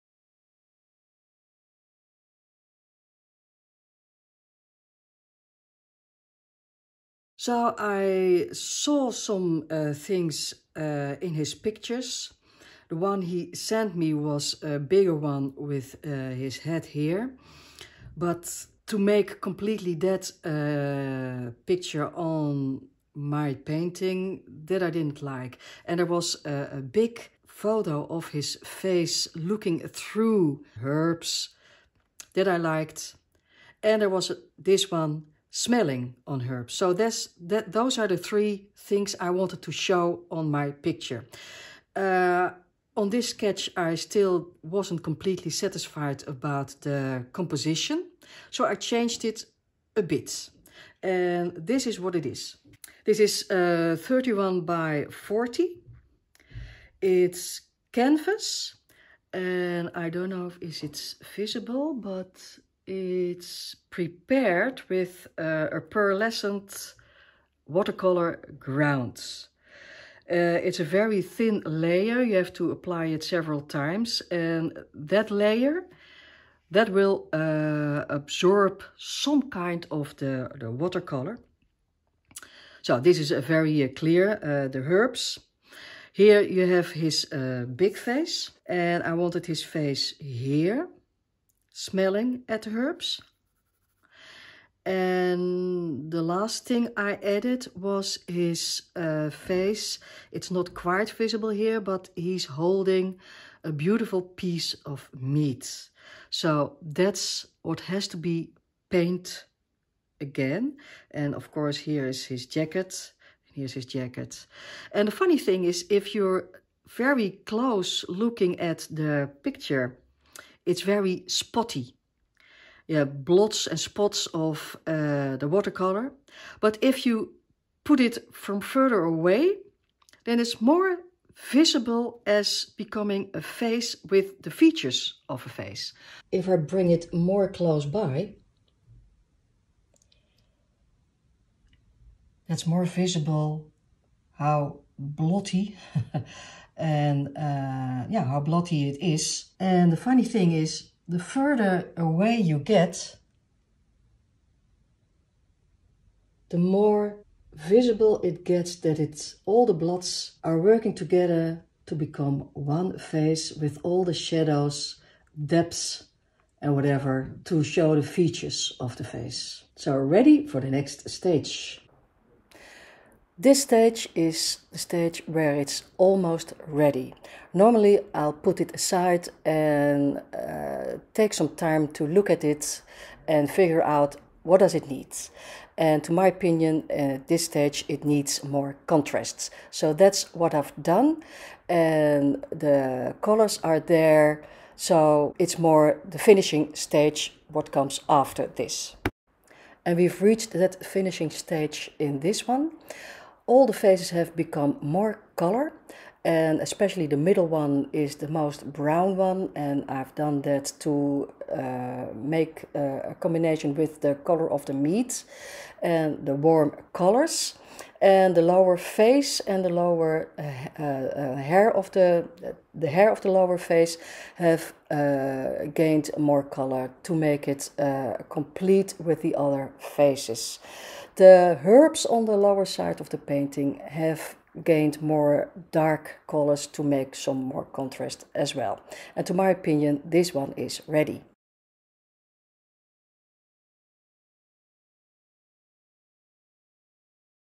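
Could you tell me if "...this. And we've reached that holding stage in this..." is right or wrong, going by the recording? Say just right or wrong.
wrong.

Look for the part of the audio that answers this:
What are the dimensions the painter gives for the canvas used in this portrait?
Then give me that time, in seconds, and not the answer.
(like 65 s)
53 s.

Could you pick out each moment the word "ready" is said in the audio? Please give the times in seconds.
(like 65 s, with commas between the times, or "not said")
169 s, 176 s, 240 s.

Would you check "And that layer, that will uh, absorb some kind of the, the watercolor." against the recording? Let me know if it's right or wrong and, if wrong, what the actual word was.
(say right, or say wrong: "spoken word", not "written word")
right.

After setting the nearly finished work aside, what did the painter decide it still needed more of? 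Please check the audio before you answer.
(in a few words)
contrasts.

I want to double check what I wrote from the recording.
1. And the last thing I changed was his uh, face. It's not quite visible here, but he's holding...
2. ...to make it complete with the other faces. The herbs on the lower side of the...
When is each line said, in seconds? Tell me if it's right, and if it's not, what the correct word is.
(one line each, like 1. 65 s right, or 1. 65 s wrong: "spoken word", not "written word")
1. 94 s wrong: "added", not "changed"
2. 227 s right.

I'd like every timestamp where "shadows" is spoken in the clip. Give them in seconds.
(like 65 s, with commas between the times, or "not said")
164 s.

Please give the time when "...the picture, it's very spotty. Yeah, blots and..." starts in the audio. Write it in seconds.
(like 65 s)
118 s.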